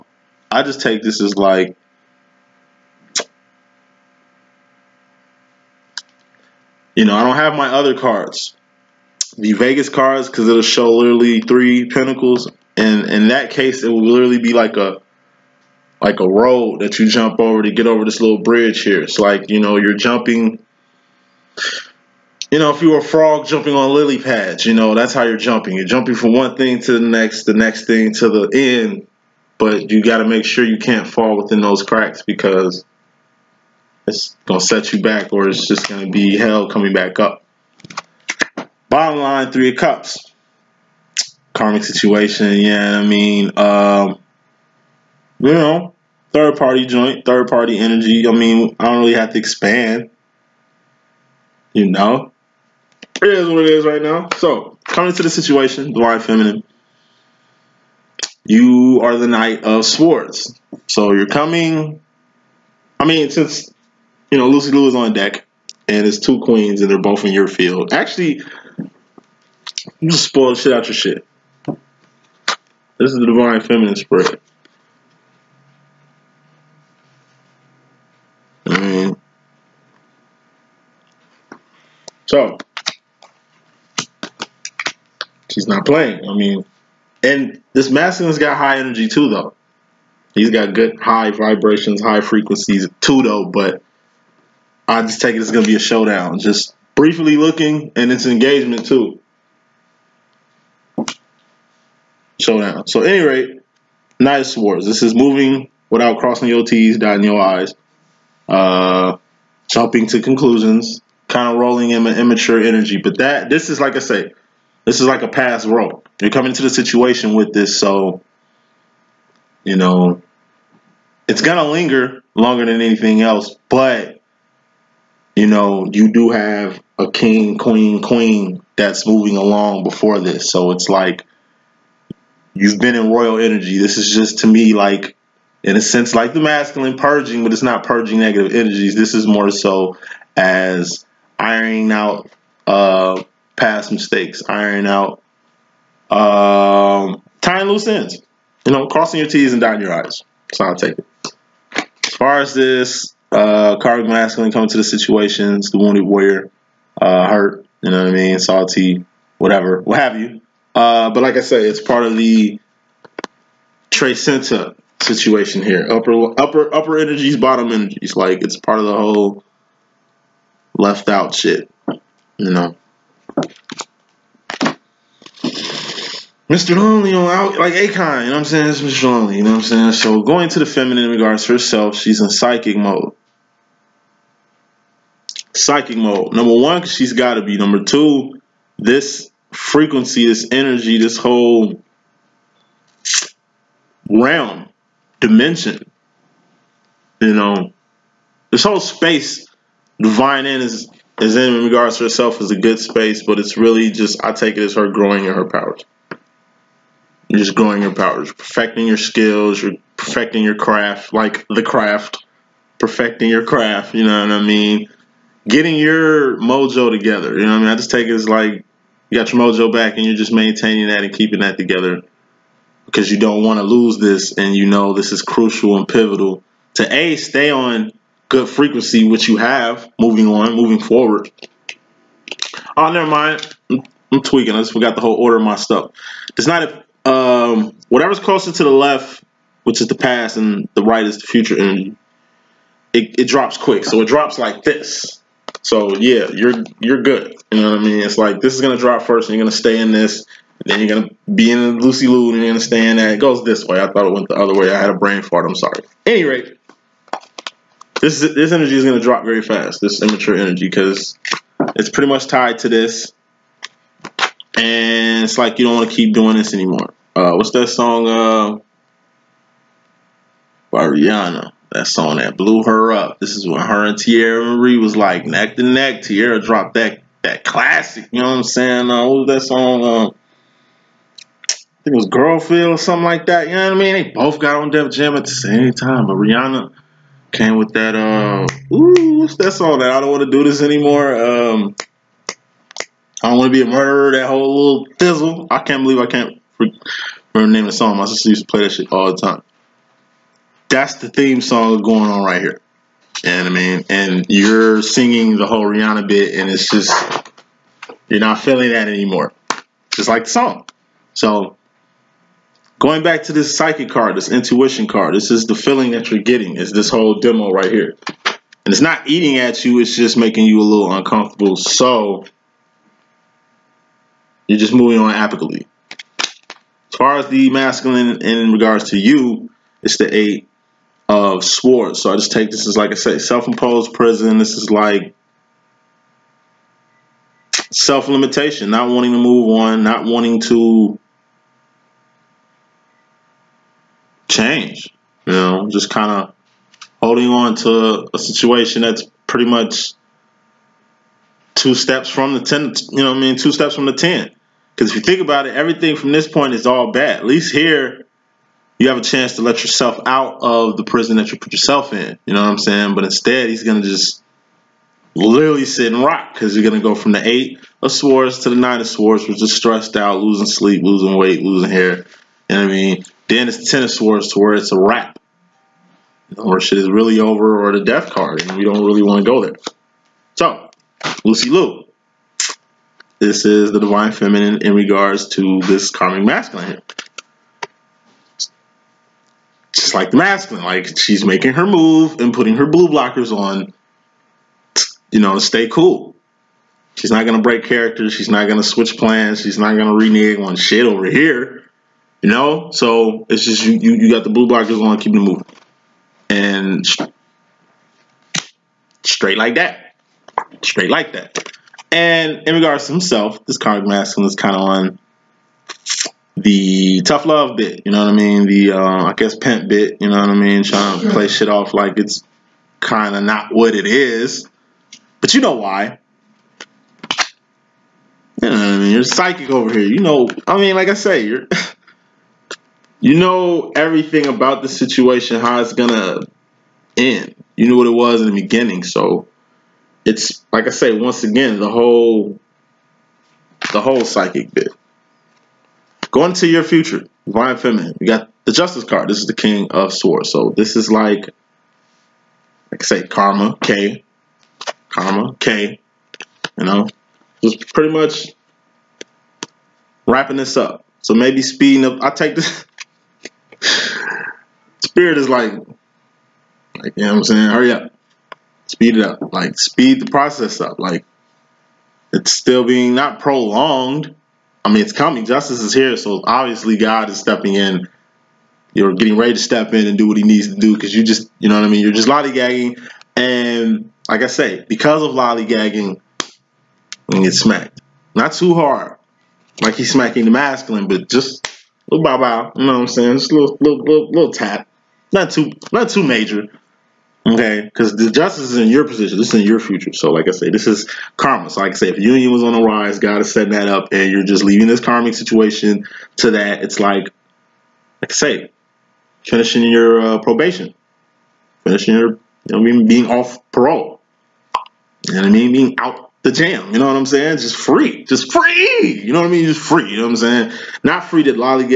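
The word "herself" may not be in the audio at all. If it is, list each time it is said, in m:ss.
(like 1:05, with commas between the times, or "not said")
3:01, 3:22.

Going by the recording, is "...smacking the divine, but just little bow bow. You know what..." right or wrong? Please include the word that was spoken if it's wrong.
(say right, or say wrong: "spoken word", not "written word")
wrong: "masculine", not "divine".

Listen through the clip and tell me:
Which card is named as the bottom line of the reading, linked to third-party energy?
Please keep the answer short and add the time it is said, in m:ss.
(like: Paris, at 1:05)
Three of Cups, at 0:39.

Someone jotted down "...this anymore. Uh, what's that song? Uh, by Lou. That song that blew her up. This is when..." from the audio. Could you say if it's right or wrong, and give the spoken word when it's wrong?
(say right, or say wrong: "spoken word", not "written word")
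wrong: "Rihanna", not "Lou".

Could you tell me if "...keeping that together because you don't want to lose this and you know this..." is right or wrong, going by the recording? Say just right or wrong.
right.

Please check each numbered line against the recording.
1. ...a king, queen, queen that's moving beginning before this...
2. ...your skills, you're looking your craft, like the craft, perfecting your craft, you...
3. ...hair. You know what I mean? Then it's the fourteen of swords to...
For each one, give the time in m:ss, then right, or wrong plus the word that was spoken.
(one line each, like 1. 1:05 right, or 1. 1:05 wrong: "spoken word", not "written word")
1. 2:06 wrong: "along", not "beginning"
2. 3:28 wrong: "perfecting", not "looking"
3. 6:11 wrong: "ten", not "fourteen".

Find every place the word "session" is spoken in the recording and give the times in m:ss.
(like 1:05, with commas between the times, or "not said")
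not said.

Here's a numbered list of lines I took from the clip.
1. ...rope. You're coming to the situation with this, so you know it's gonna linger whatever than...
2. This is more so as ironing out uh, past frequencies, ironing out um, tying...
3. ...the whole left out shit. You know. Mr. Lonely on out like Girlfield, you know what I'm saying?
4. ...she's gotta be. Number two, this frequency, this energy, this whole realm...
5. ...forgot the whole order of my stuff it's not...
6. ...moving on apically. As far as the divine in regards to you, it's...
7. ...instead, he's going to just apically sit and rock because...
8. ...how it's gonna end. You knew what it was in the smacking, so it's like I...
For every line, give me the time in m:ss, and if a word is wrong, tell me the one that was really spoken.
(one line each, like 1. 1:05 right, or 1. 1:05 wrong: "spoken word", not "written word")
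1. 1:55 wrong: "longer", not "whatever"
2. 2:18 wrong: "mistakes", not "frequencies"
3. 2:48 wrong: "Akon", not "Girlfield"
4. 3:06 right
5. 3:54 right
6. 5:24 wrong: "masculine", not "divine"
7. 6:03 wrong: "literally", not "apically"
8. 7:15 wrong: "beginning", not "smacking".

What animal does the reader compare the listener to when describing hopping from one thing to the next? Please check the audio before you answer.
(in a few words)
A frog.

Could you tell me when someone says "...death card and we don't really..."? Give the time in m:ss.
6:17.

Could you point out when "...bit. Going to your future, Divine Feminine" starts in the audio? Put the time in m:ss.
7:24.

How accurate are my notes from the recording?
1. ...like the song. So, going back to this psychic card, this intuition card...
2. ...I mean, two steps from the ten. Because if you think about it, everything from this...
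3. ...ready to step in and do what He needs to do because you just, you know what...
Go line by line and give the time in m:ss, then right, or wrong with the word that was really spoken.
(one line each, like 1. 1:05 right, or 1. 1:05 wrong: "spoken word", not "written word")
1. 5:10 right
2. 5:53 right
3. 7:59 right.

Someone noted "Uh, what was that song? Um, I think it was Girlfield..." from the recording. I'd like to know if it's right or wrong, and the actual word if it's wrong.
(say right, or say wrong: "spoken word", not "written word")
right.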